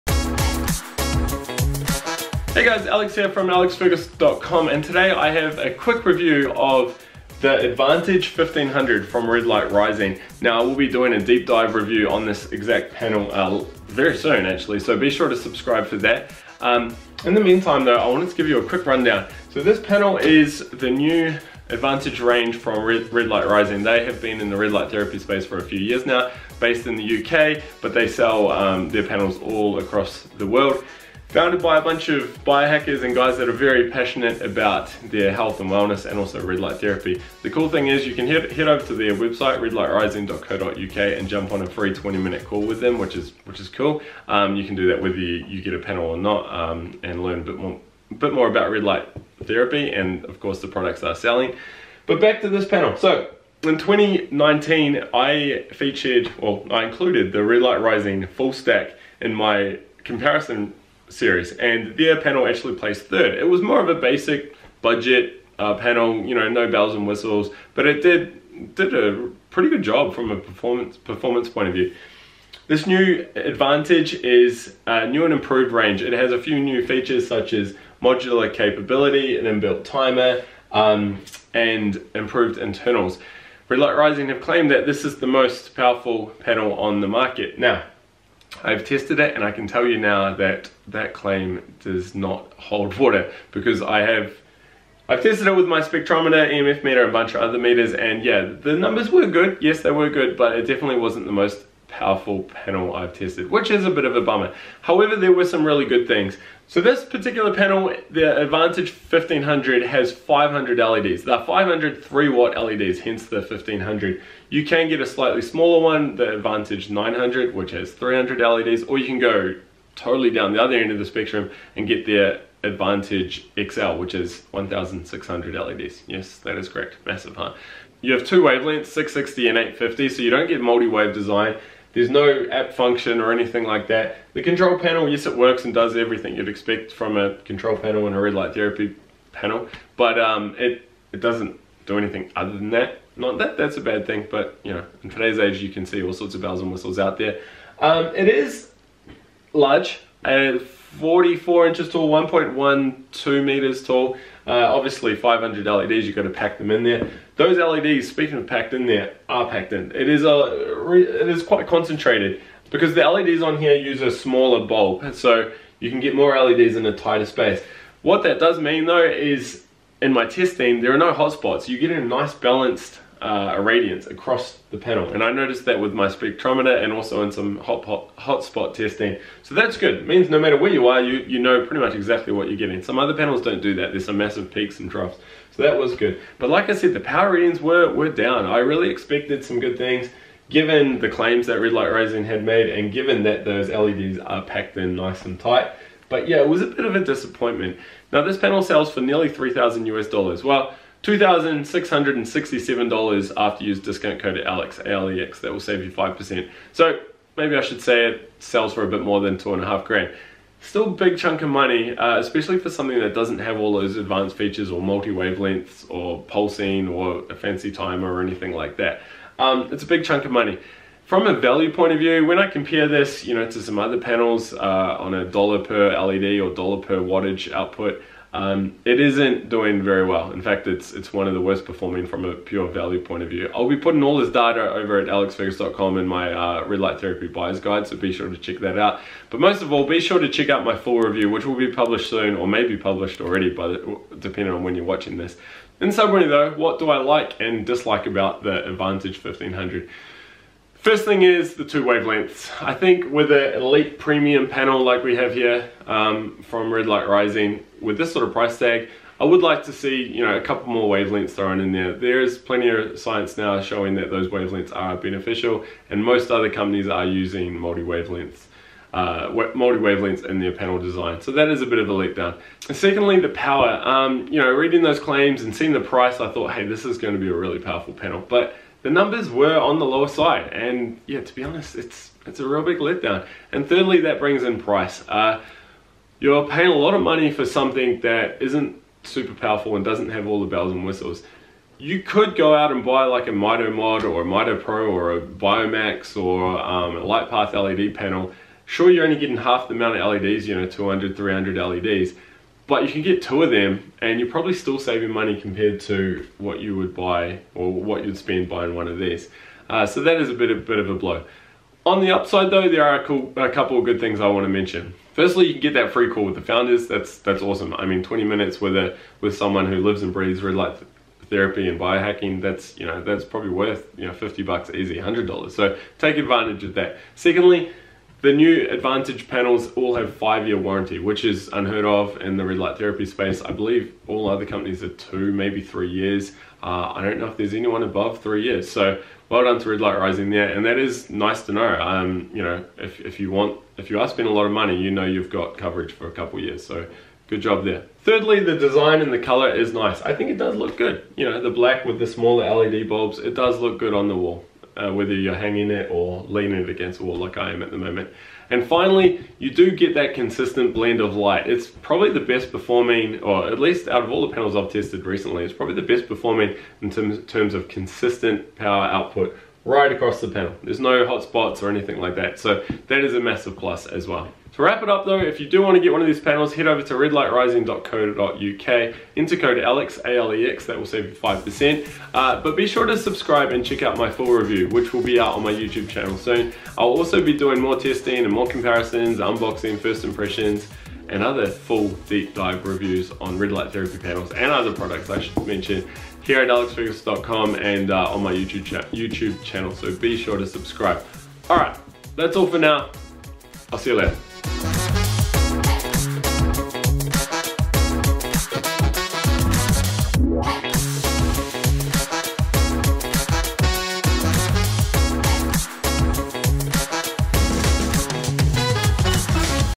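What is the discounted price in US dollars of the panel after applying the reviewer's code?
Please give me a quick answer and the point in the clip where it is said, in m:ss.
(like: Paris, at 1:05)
$2,667, at 3:21.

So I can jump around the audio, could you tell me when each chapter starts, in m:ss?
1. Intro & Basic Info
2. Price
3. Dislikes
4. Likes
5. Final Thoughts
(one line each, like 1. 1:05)
1. 0:50
2. 3:18
3. 4:05
4. 5:10
5. 6:14.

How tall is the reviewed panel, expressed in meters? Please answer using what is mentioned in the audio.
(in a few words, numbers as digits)
1.12 meters.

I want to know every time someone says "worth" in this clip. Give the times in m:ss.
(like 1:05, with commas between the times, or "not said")
5:23.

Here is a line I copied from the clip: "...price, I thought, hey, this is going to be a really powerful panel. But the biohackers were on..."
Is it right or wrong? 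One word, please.
wrong.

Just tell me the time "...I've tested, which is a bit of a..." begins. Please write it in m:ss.
1:42.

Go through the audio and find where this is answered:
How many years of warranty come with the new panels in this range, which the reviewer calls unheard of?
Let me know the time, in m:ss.
5:30.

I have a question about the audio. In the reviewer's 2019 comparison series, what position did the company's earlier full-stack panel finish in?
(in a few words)
third.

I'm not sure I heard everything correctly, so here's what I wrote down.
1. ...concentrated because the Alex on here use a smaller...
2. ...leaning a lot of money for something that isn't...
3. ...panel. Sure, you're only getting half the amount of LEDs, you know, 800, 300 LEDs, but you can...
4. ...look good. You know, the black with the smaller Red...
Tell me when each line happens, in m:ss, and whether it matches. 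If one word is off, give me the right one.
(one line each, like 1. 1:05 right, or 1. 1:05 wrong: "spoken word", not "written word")
1. 2:41 wrong: "LEDs", not "Alex"
2. 4:46 wrong: "paying", not "leaning"
3. 4:57 wrong: "200", not "800"
4. 5:50 wrong: "LED", not "Red".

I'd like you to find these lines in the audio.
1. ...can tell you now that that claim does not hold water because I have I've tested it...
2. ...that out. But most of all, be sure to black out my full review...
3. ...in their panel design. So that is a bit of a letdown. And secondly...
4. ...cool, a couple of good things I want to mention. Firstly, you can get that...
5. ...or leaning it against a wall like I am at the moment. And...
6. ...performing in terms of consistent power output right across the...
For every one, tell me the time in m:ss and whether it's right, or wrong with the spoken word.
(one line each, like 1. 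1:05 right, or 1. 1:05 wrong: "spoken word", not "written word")
1. 1:29 right
2. 3:58 wrong: "check", not "black"
3. 4:30 right
4. 5:13 right
5. 5:55 right
6. 6:06 right.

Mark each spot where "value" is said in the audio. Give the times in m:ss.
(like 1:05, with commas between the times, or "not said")
3:41, 3:52.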